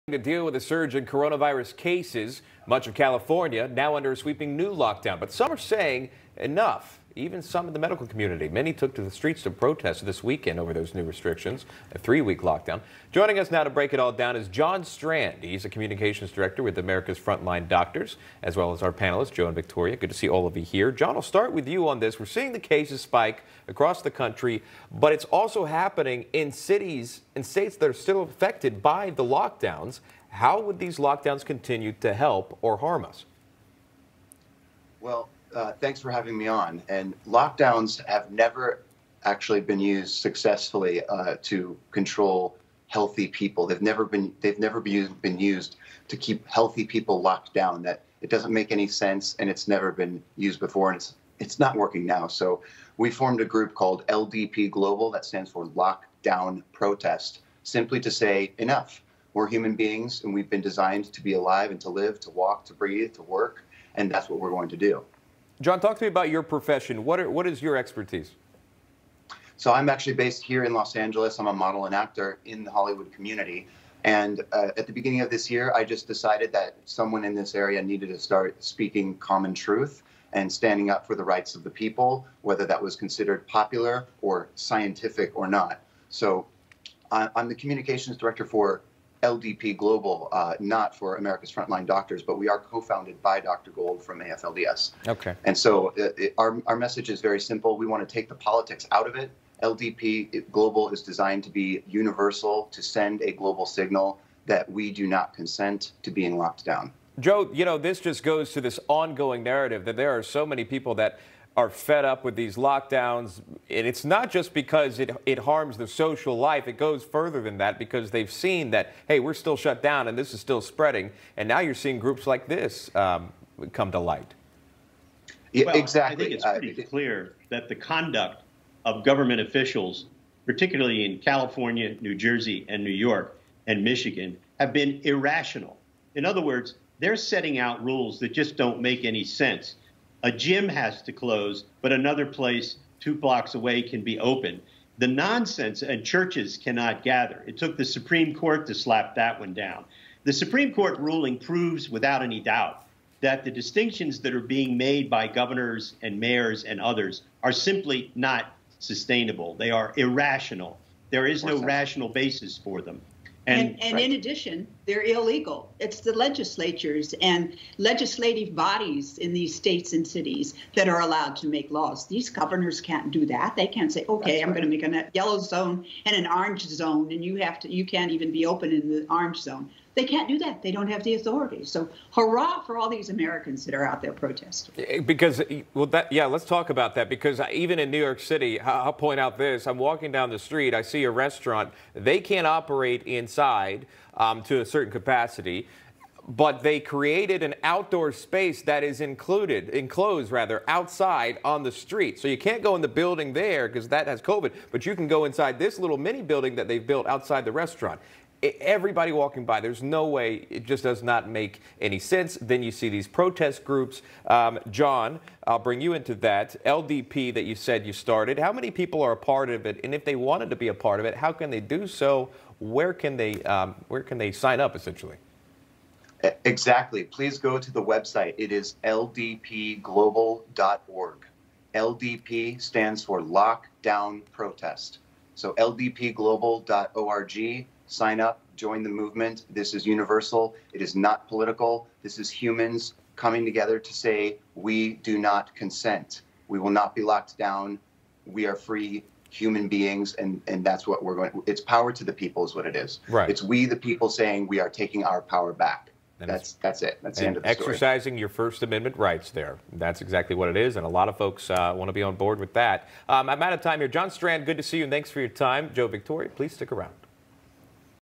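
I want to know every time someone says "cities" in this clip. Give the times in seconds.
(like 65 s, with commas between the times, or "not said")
26 s, 170 s.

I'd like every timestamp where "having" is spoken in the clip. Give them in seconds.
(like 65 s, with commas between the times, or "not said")
36 s.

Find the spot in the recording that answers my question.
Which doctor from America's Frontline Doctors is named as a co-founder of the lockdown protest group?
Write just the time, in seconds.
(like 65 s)
93 s.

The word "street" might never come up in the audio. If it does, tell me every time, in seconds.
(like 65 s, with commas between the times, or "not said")
9 s, 190 s, 201 s.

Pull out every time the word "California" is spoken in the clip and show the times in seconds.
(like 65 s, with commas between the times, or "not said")
2 s, 131 s.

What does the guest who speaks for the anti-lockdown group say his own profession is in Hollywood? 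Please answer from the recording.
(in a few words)
model and actor.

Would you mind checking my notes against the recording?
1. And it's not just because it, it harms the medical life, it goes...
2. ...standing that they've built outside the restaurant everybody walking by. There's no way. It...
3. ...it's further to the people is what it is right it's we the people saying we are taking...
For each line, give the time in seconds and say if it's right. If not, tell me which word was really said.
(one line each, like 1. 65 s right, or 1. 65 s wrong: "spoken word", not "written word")
1. 113 s wrong: "social", not "medical"
2. 206 s wrong: "building", not "standing"
3. 251 s wrong: "power", not "further".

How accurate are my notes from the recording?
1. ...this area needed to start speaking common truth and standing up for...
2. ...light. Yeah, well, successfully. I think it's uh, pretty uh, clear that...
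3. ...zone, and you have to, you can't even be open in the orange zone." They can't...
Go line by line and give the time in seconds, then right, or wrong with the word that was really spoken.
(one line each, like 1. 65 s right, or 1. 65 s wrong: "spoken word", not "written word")
1. 77 s right
2. 123 s wrong: "exactly", not "successfully"
3. 176 s right.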